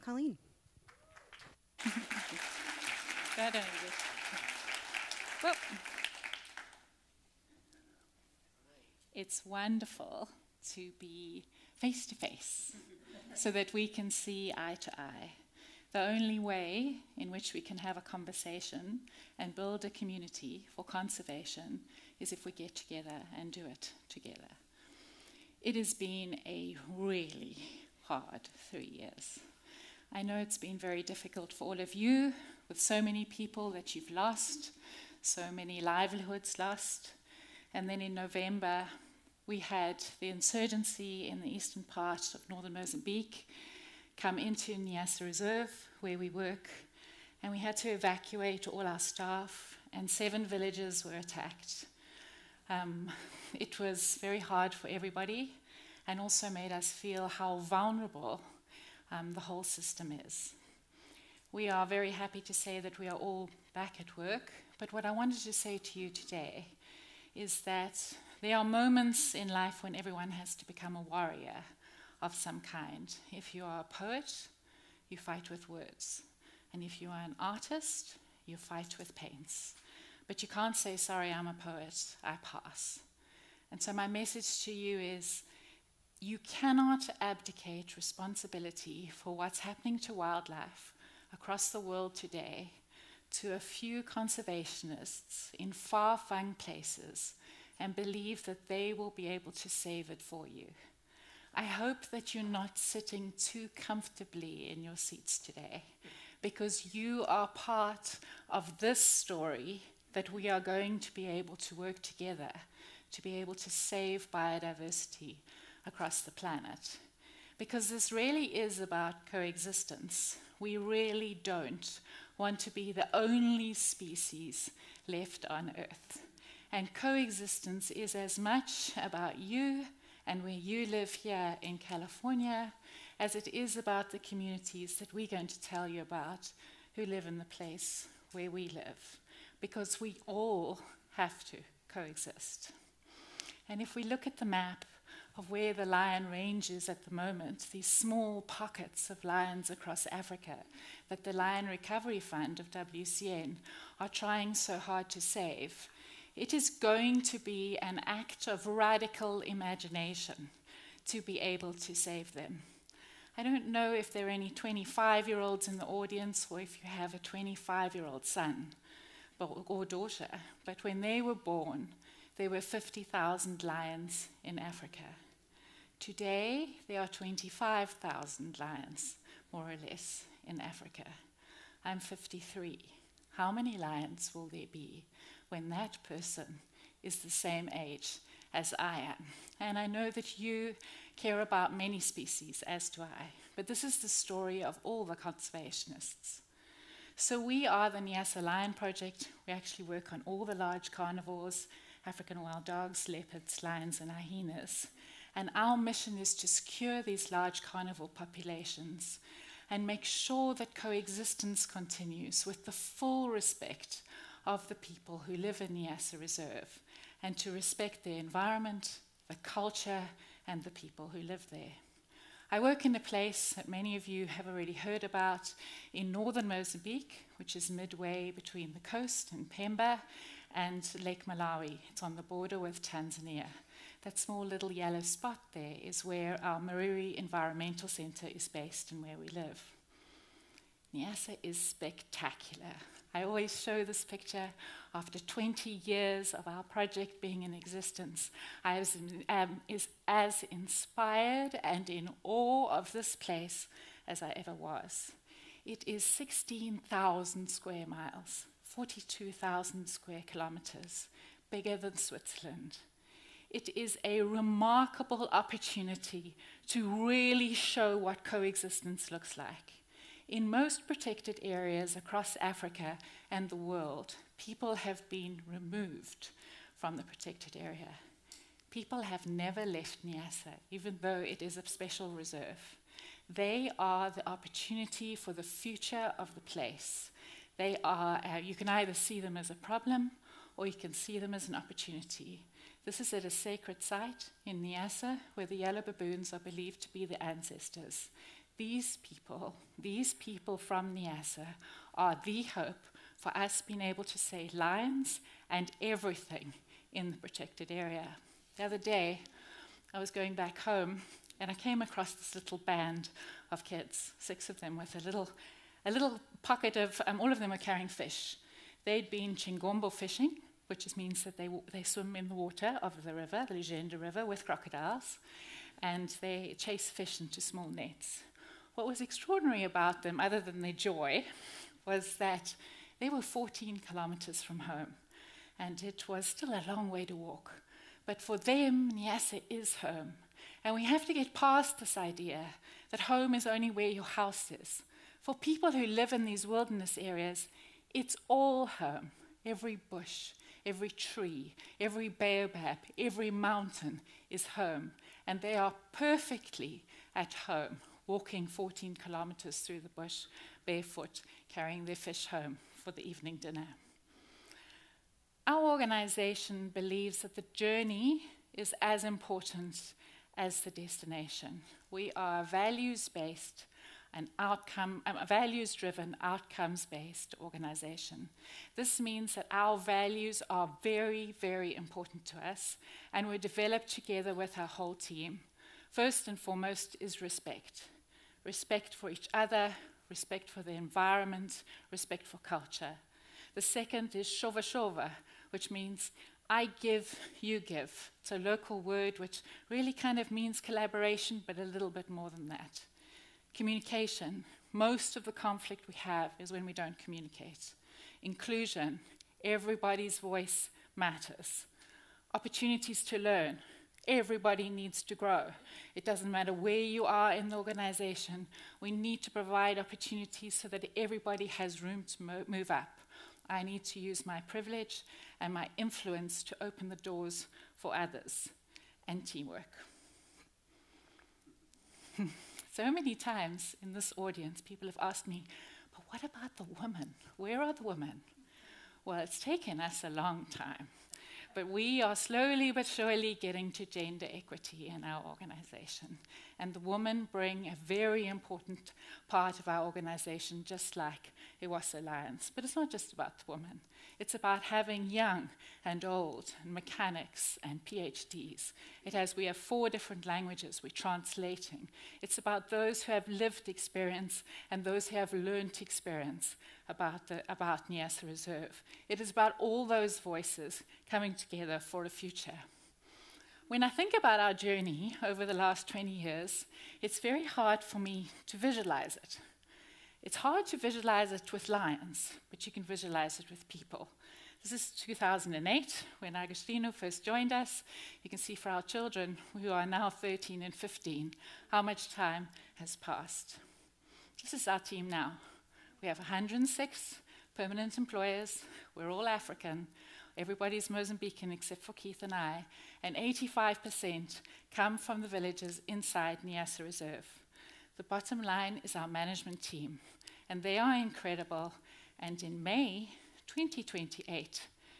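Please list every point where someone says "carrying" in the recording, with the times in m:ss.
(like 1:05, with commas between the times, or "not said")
5:17, 6:01.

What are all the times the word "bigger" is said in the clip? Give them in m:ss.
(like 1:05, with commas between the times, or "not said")
4:21.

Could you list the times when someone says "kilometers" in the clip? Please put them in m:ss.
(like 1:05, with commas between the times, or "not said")
4:20, 5:33, 5:59.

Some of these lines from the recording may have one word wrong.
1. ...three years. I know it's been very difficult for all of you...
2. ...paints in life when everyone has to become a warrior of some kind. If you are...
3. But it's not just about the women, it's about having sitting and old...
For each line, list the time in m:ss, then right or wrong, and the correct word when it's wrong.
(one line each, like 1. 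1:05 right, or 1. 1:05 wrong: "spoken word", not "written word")
1. 0:28 right
2. 1:08 wrong: "moments", not "paints"
3. 7:32 wrong: "young", not "sitting".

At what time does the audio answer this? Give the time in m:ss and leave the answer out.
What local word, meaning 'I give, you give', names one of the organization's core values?
6:34.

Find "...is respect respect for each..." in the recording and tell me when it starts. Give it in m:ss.
6:26.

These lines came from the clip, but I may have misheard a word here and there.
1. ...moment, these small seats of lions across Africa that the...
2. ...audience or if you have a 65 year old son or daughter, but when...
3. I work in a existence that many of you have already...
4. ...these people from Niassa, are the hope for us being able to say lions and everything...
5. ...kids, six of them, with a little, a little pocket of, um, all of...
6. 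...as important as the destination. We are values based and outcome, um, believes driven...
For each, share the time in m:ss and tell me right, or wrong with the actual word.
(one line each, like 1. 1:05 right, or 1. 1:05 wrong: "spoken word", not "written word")
1. 2:27 wrong: "pockets", not "seats"
2. 2:45 wrong: "25", not "65"
3. 3:42 wrong: "place", not "existence"
4. 4:59 right
5. 5:13 right
6. 6:08 wrong: "values", not "believes".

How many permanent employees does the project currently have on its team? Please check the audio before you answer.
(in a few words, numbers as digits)
106.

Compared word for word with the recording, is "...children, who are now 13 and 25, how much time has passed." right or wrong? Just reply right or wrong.
wrong.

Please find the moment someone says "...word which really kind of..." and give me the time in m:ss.
6:38.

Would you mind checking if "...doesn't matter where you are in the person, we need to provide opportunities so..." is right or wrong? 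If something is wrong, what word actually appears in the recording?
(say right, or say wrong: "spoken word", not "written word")
wrong: "organization", not "person".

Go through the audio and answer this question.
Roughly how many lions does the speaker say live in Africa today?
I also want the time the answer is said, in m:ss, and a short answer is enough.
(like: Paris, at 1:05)
25,000, at 2:57.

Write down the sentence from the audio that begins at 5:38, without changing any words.
But for them, Niassa is home.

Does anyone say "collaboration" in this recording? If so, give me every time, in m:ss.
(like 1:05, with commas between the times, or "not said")
6:40.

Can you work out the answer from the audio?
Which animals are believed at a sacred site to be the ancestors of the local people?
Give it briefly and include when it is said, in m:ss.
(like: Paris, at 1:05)
yellow baboons, at 4:55.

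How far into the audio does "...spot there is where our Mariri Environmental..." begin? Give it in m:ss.
3:55.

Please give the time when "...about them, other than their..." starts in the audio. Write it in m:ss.
5:29.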